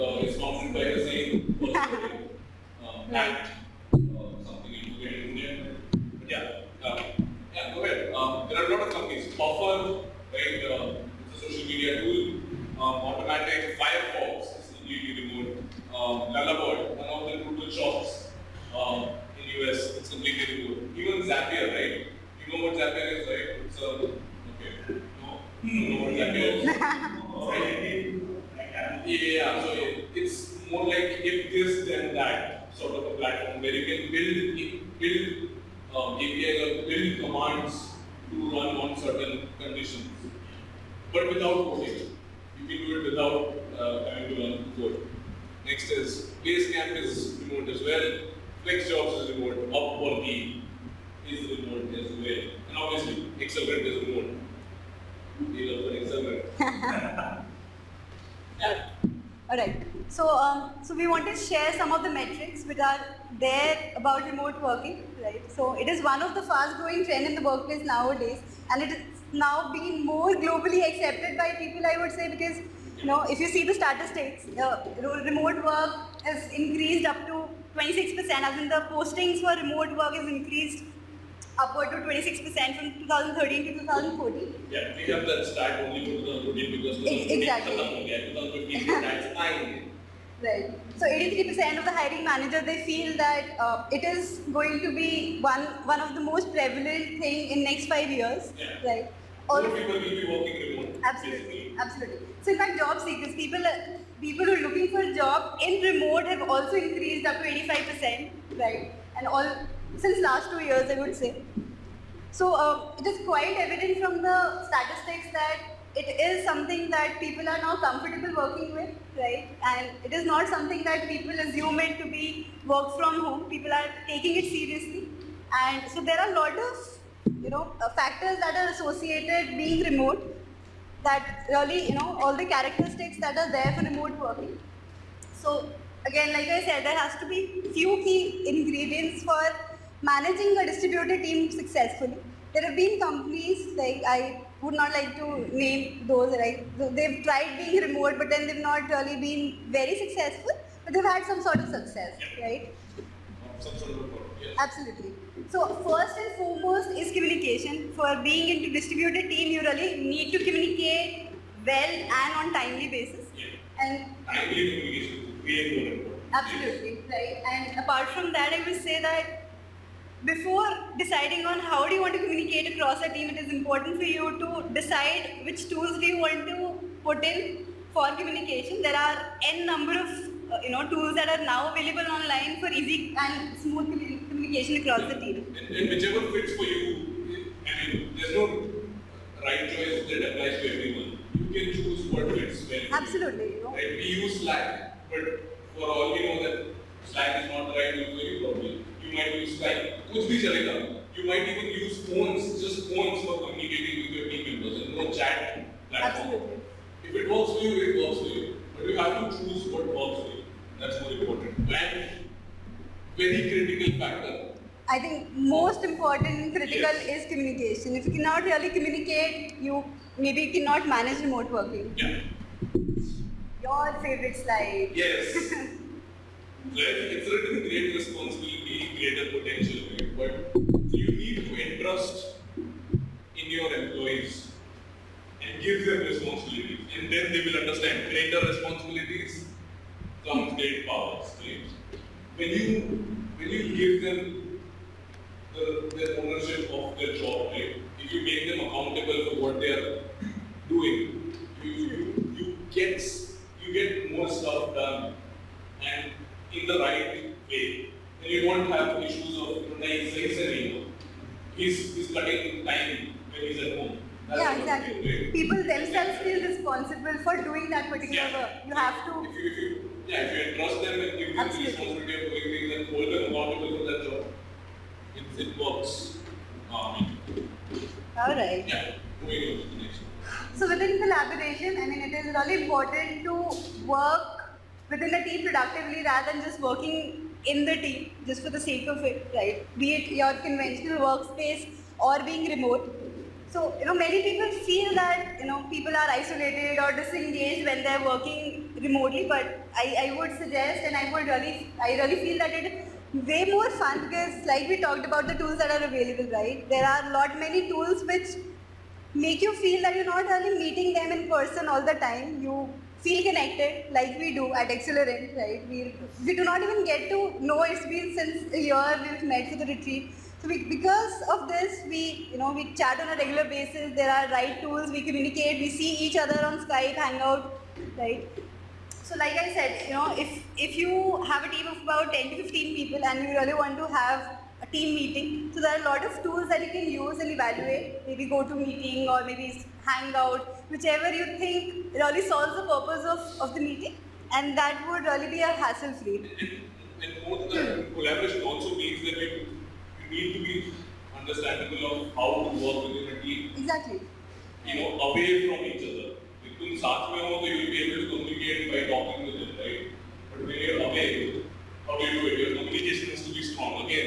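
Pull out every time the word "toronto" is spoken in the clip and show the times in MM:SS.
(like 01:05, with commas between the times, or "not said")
not said.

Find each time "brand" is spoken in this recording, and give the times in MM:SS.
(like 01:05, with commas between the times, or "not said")
not said.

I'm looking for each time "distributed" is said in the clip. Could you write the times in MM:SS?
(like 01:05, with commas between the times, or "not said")
02:20, 02:38.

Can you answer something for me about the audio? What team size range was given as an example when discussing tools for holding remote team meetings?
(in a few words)
10 to 15 people.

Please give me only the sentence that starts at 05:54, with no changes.
You know, away from each other.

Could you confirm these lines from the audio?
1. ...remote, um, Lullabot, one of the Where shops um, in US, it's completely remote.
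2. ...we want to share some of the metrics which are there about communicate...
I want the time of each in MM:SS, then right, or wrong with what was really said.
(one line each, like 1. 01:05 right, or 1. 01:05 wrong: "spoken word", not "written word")
1. 00:15 wrong: "Drupal", not "Where"
2. 01:00 wrong: "remote", not "communicate".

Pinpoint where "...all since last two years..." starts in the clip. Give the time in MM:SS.
01:49.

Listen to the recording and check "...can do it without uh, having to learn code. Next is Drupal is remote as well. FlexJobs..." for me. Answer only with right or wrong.
wrong.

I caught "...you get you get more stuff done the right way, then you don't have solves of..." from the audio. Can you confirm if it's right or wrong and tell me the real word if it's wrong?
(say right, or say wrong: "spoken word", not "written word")
wrong: "issues", not "solves".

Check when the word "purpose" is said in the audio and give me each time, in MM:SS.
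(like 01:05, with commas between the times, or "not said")
05:42.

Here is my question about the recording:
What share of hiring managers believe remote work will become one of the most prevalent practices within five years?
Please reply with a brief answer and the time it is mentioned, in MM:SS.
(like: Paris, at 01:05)
83%, at 01:31.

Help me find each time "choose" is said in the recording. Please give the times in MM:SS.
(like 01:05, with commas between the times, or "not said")
03:11, 03:29.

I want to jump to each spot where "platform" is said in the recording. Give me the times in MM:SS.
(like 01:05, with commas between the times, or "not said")
00:33, 03:25.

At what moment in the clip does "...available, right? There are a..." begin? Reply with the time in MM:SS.
05:05.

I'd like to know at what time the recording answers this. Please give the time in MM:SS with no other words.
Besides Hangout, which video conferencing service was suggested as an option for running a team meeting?
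05:38.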